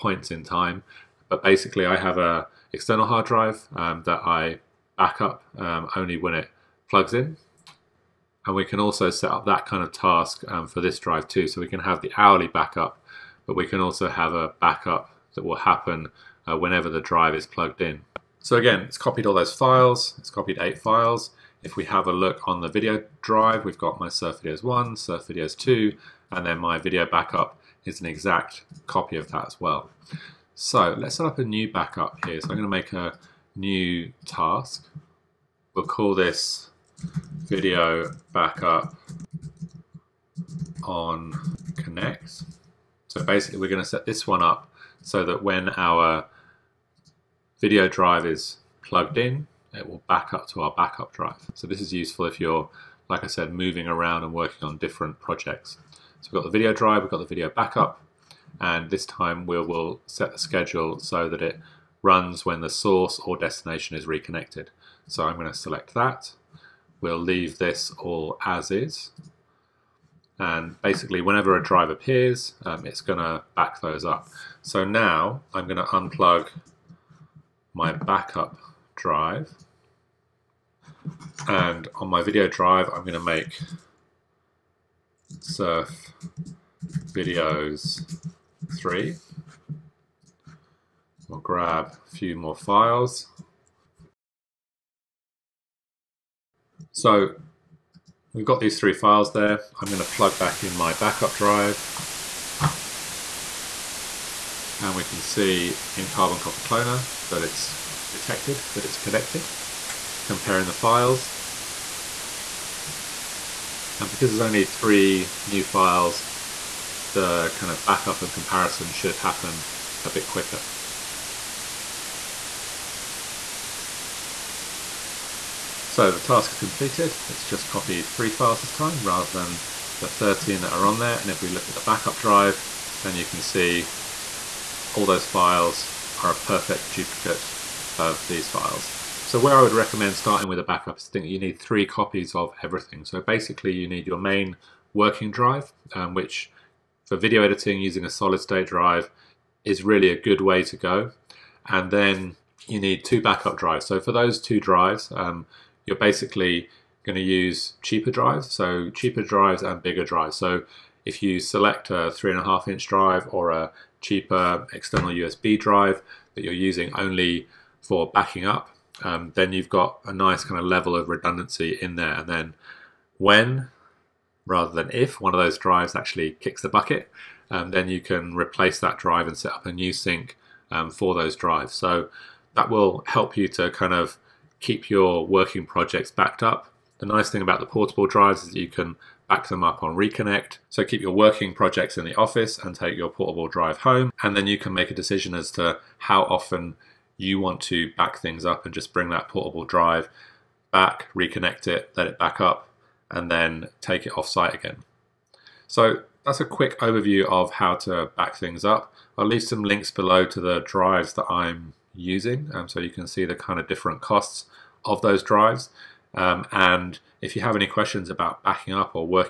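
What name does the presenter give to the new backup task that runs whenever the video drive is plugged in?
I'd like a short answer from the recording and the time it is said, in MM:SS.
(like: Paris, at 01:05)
video backup on connect, at 00:37.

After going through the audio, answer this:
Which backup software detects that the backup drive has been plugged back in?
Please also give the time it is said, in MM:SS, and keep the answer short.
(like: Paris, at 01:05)
Carbon Copy Cloner, at 01:46.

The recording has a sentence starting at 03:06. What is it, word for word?
The nice thing about the portable drives is that you can back them up on Reconnect.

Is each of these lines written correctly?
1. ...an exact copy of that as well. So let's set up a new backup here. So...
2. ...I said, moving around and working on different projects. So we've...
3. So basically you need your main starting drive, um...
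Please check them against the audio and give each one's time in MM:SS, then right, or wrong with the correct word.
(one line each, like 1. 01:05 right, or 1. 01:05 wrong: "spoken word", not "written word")
1. 00:27 right
2. 00:53 right
3. 02:23 wrong: "working", not "starting".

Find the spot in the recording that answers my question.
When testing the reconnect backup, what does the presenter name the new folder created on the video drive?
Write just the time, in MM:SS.
01:25.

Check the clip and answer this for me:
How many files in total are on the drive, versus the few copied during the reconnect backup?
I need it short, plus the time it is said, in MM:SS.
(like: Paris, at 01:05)
13, at 02:10.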